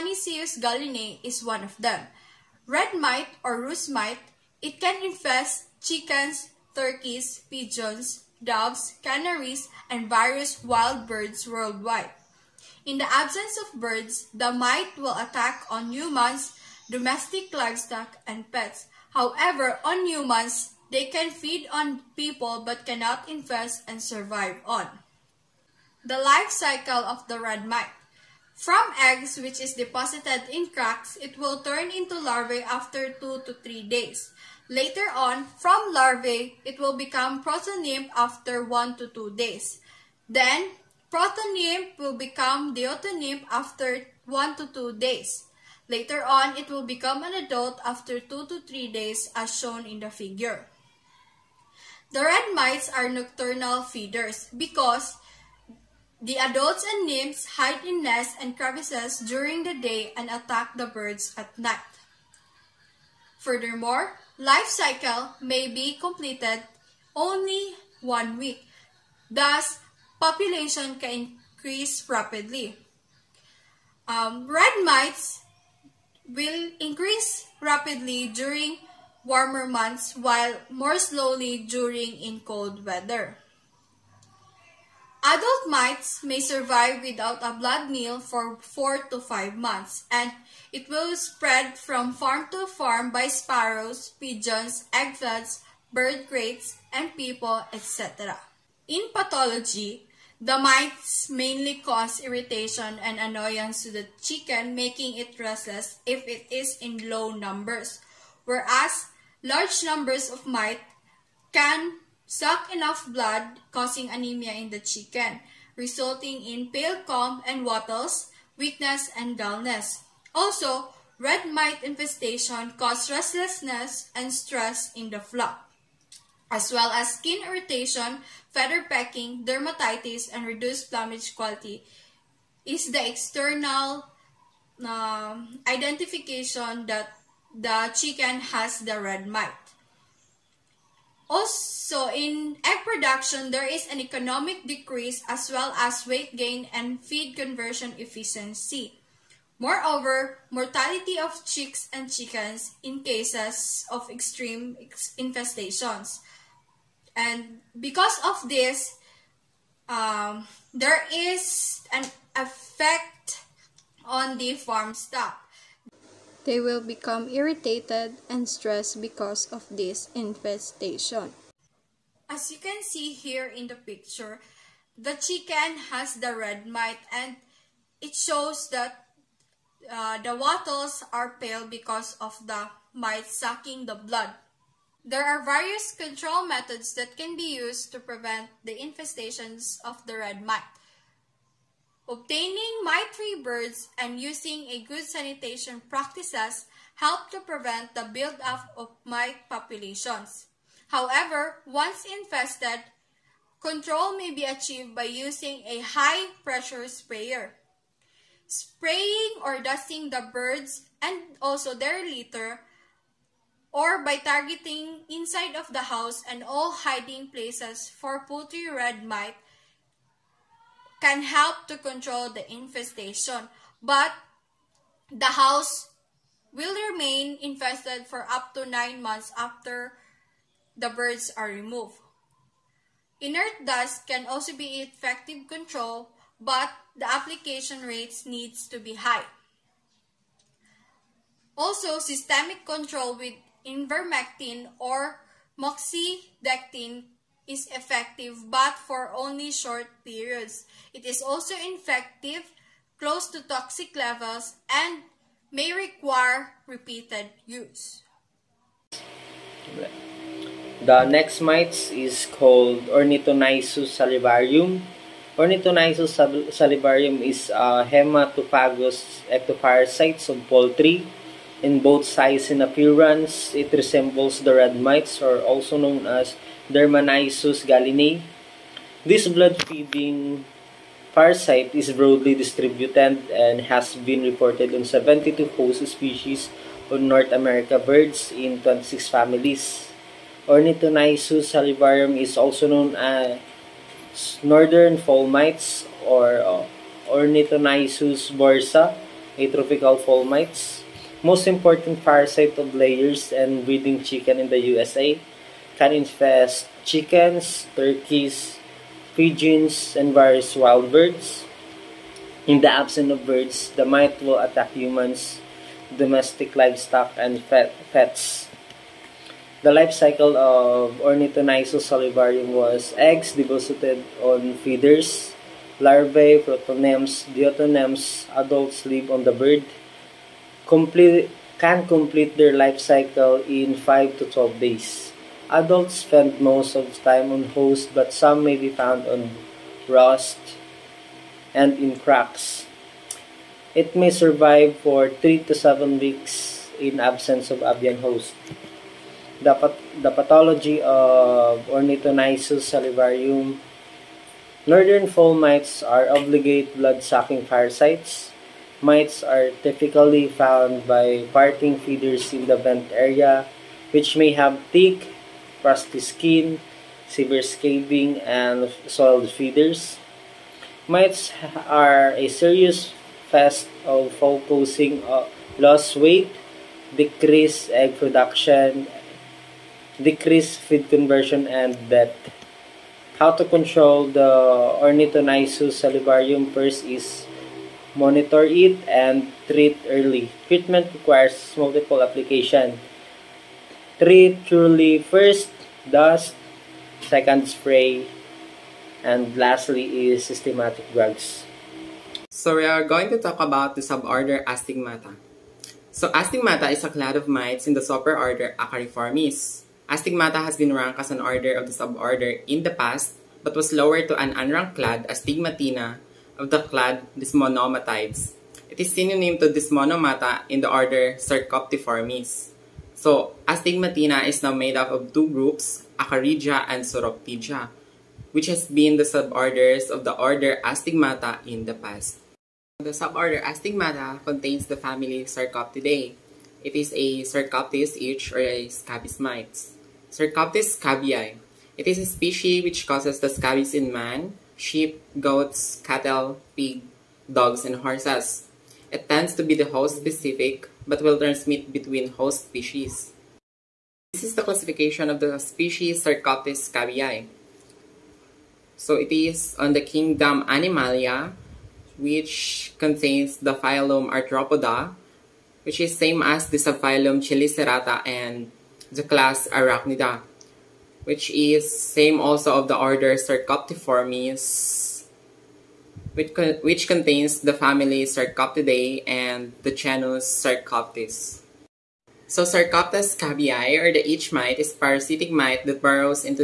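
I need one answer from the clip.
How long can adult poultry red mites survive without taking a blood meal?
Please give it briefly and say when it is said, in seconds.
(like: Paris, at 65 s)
4 to 5 months, at 88 s.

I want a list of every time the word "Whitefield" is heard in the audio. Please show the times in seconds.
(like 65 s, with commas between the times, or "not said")
not said.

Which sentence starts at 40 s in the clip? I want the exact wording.
Then, protonymph will become deutonymph after 1 to 2 days.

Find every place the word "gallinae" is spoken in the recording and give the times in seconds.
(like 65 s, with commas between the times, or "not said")
0 s, 277 s.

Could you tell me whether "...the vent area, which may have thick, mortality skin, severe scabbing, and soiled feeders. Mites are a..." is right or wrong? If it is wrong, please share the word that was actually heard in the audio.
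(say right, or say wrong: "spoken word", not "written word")
wrong: "crusty", not "mortality".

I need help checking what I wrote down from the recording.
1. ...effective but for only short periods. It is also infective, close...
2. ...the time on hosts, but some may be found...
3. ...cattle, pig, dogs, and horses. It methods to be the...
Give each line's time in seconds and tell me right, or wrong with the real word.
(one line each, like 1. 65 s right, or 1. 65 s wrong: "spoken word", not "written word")
1. 247 s right
2. 336 s right
3. 445 s wrong: "tends", not "methods".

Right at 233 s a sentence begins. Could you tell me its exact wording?
Inert dust can also be effective control, but the application rates needs to be high.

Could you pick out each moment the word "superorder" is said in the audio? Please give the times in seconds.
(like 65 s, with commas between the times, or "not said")
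407 s.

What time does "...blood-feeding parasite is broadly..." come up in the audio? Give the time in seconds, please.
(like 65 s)
279 s.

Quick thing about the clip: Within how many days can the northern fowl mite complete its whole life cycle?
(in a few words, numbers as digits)
5 to 12 days.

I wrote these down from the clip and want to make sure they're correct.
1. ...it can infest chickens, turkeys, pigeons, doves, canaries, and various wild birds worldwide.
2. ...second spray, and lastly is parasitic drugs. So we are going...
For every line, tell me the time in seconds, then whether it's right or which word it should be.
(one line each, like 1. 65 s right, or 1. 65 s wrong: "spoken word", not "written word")
1. 4 s right
2. 397 s wrong: "systematic", not "parasitic".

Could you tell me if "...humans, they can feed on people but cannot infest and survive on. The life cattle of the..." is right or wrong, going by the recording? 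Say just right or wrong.
wrong.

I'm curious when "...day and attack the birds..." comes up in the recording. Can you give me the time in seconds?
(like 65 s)
59 s.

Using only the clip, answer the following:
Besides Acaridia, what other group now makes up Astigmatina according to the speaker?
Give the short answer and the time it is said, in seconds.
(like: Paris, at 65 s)
Psoroptidia, at 426 s.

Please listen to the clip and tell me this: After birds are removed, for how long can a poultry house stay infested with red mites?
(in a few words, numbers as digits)
9 months.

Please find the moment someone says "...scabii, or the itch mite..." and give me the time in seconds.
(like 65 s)
483 s.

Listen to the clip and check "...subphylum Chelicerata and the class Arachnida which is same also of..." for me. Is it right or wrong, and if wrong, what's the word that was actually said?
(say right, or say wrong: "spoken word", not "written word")
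right.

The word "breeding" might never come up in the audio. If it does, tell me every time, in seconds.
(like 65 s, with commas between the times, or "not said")
303 s.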